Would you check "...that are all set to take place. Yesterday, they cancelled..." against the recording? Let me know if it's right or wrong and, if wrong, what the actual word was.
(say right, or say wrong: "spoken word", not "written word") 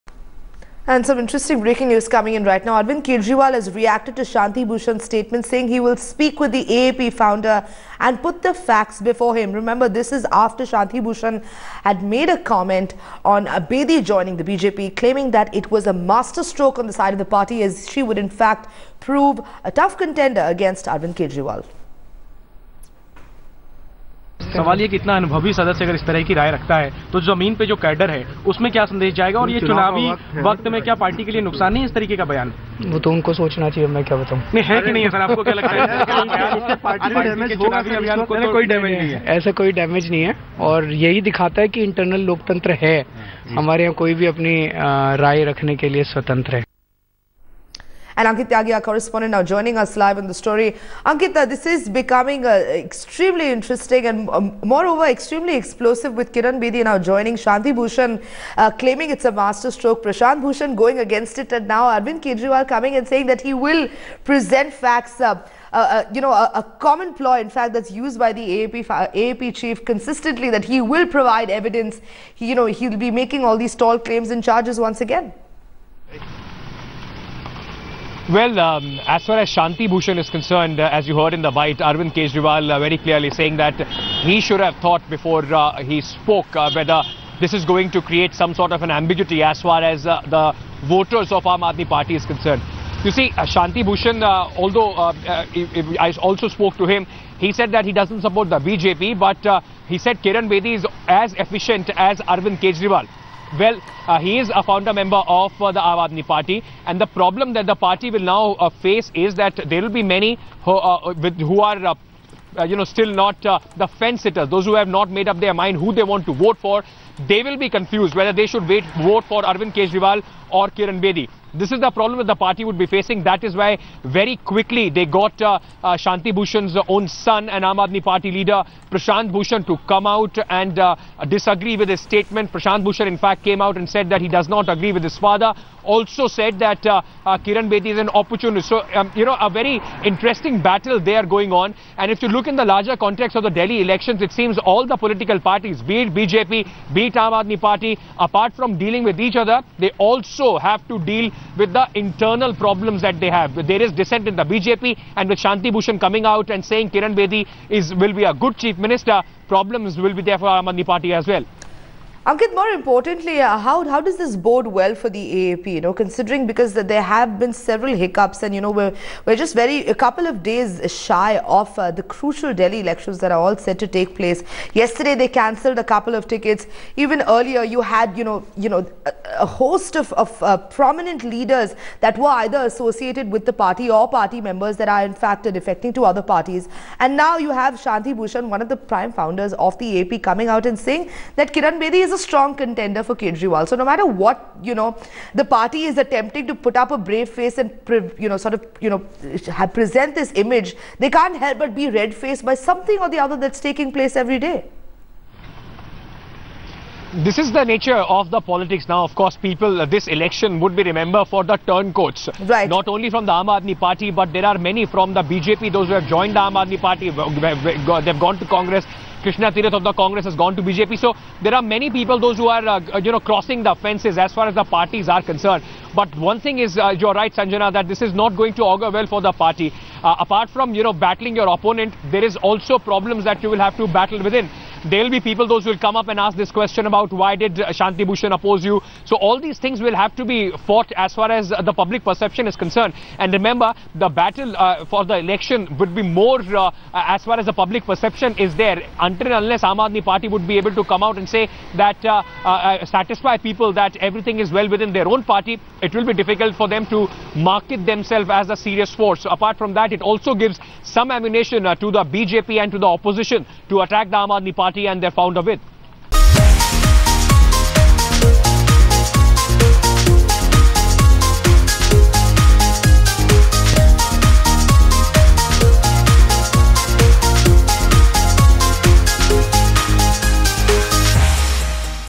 right.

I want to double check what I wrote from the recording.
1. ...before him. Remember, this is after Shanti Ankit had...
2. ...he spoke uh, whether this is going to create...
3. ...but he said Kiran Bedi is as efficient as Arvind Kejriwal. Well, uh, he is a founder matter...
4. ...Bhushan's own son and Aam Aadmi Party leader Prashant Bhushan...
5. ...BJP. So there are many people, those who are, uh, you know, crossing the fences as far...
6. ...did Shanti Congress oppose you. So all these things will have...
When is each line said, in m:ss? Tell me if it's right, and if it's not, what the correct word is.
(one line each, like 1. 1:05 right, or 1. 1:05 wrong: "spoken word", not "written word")
1. 0:08 wrong: "Bhushan", not "Ankit"
2. 1:25 right
3. 1:39 wrong: "member", not "matter"
4. 2:06 right
5. 3:40 right
6. 3:57 wrong: "Bhushan", not "Congress".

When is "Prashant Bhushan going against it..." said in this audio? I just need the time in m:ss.
1:00.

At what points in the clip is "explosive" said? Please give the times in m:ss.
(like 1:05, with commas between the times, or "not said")
0:55.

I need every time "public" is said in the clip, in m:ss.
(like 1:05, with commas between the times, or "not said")
4:01, 4:07.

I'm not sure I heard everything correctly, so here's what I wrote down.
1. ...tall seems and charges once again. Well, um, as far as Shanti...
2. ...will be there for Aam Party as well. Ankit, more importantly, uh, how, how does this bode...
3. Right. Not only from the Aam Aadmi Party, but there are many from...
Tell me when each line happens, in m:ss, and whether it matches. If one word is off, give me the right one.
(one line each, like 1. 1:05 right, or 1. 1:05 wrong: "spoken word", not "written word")
1. 1:13 wrong: "claims", not "seems"
2. 2:39 right
3. 3:32 right.